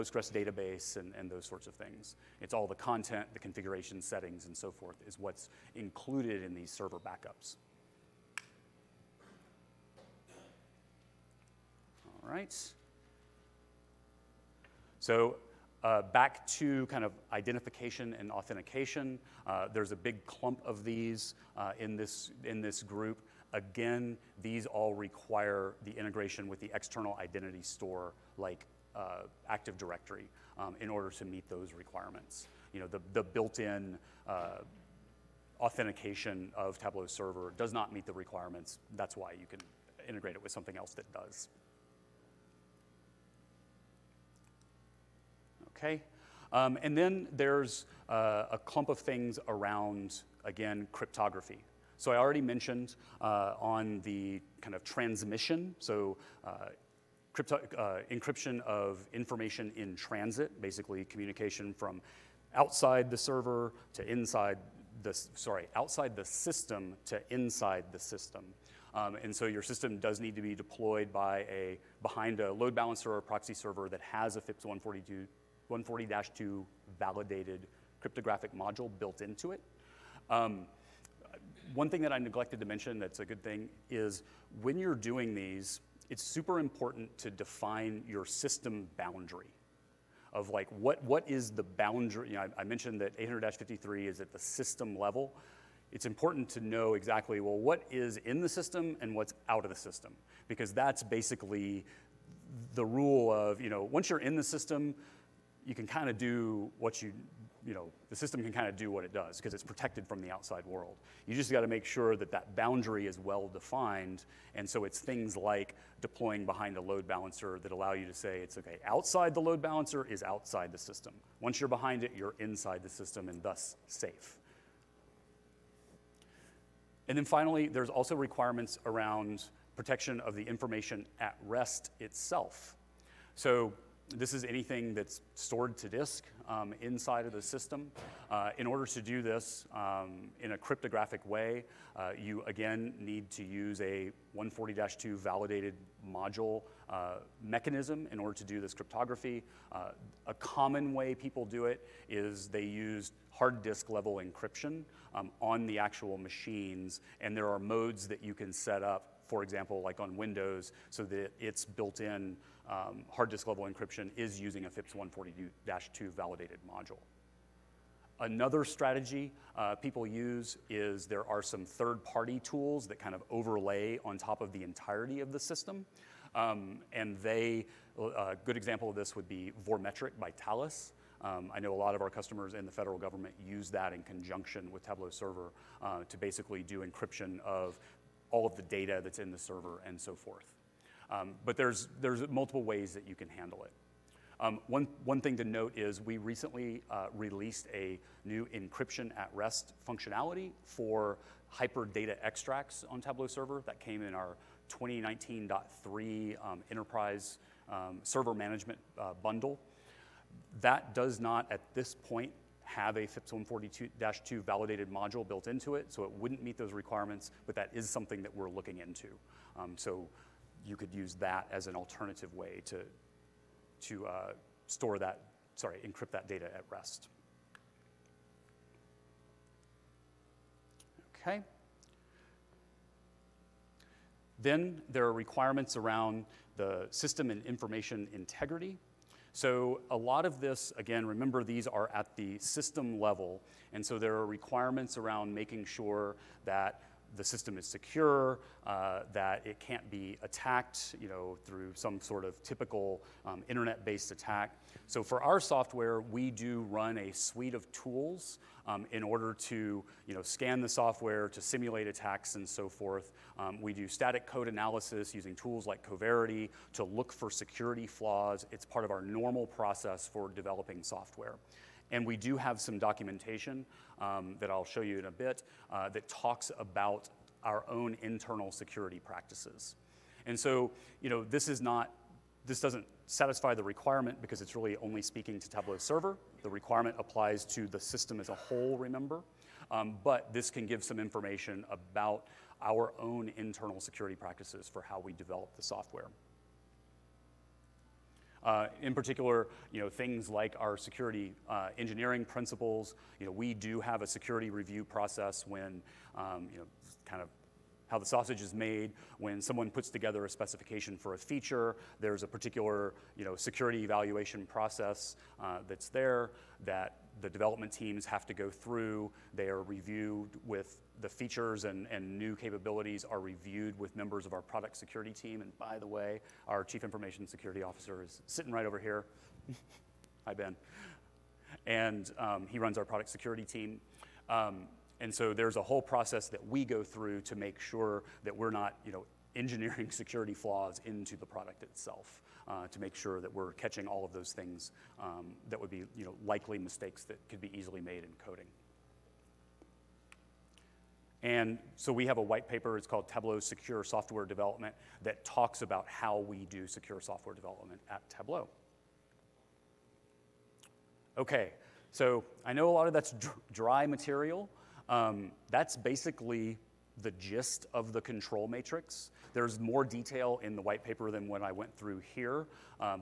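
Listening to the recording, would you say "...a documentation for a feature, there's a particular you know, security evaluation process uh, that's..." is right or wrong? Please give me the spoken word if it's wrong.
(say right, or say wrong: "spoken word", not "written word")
wrong: "specification", not "documentation".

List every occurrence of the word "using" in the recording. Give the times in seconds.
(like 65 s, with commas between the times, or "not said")
164 s, 265 s.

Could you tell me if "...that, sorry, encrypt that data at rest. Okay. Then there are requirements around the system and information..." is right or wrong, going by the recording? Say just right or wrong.
right.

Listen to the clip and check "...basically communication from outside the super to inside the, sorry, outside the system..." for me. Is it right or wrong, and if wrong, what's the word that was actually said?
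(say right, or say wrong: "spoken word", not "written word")
wrong: "server", not "super".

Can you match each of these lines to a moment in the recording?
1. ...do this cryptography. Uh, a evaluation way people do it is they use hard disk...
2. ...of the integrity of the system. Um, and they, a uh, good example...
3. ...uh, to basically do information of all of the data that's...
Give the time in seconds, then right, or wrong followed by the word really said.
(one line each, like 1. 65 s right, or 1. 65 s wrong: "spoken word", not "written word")
1. 148 s wrong: "common", not "evaluation"
2. 174 s wrong: "entirety", not "integrity"
3. 185 s wrong: "encryption", not "information".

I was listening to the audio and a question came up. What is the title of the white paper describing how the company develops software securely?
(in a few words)
Tableau Secure Software Development.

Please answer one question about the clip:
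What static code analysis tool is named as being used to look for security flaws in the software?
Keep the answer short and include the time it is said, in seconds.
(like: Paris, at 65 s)
Coverity, at 265 s.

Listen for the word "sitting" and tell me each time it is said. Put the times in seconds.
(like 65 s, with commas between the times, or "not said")
328 s.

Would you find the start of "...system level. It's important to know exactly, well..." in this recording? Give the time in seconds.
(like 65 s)
94 s.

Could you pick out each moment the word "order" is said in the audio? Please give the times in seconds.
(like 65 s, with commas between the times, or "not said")
30 s, 138 s, 148 s, 259 s.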